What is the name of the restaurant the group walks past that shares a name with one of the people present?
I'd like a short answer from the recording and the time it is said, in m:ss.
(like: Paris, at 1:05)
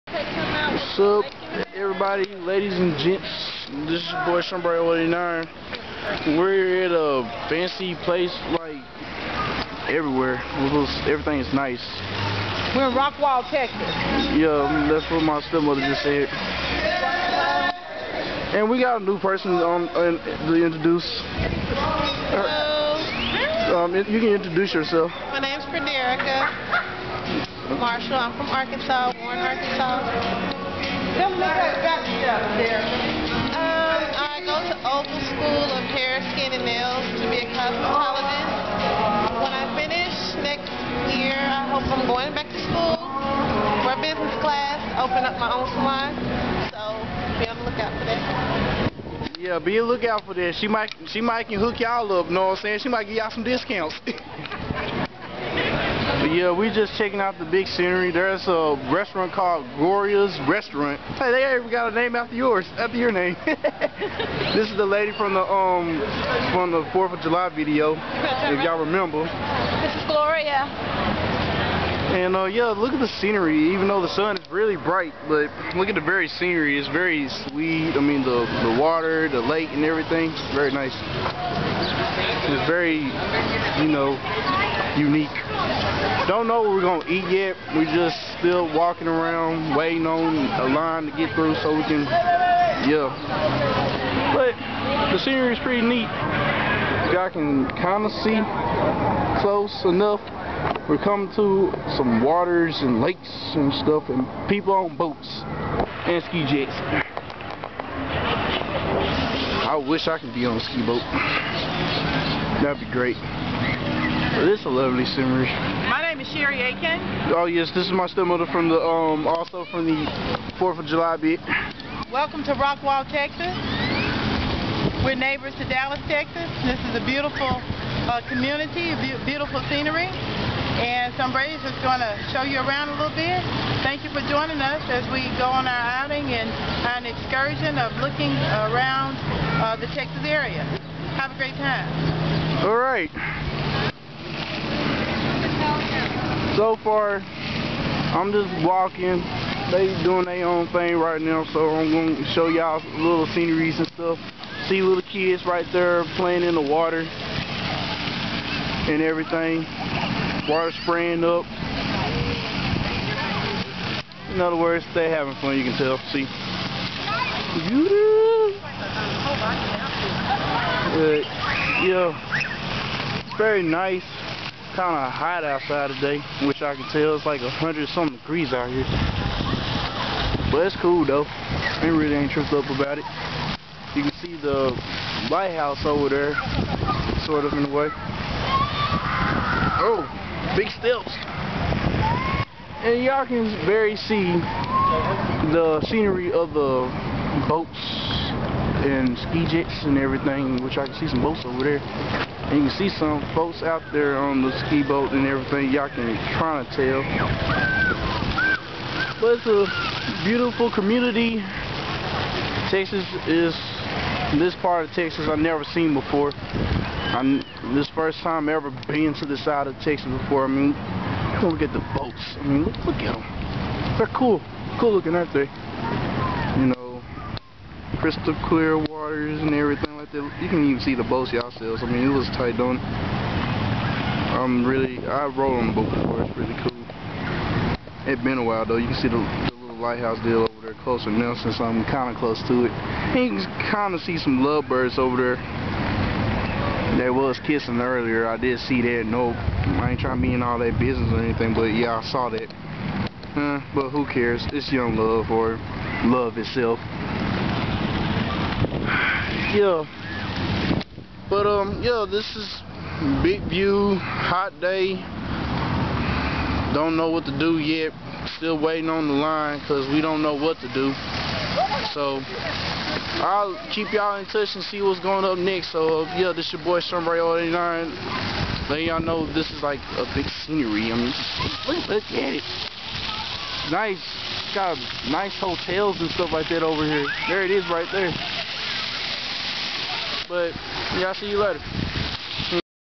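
Gloria's Restaurant, at 0:59.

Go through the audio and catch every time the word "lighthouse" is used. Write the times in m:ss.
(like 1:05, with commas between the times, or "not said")
3:05, 3:59.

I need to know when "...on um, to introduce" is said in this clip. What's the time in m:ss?
0:19.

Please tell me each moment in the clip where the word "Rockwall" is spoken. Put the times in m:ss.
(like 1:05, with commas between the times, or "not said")
0:12, 2:02.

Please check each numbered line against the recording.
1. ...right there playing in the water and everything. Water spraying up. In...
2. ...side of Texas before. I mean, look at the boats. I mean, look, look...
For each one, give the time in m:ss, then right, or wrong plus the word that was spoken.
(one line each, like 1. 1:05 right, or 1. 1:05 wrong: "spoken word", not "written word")
1. 2:35 right
2. 3:39 right.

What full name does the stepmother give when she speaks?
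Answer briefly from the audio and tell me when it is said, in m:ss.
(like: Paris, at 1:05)
Sherry Aiken, at 1:56.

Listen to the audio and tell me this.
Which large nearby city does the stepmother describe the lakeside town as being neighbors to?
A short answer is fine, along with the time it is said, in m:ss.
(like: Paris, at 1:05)
Dallas, at 2:05.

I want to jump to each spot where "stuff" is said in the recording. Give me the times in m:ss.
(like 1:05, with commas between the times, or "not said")
0:32, 1:43, 2:33, 4:46.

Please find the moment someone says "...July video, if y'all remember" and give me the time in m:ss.
1:07.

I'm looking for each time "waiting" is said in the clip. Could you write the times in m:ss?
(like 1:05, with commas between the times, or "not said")
1:29, 4:28.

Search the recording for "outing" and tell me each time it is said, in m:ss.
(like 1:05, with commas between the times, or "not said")
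2:16.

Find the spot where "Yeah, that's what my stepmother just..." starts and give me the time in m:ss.
0:14.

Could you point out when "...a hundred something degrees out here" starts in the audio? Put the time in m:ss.
2:57.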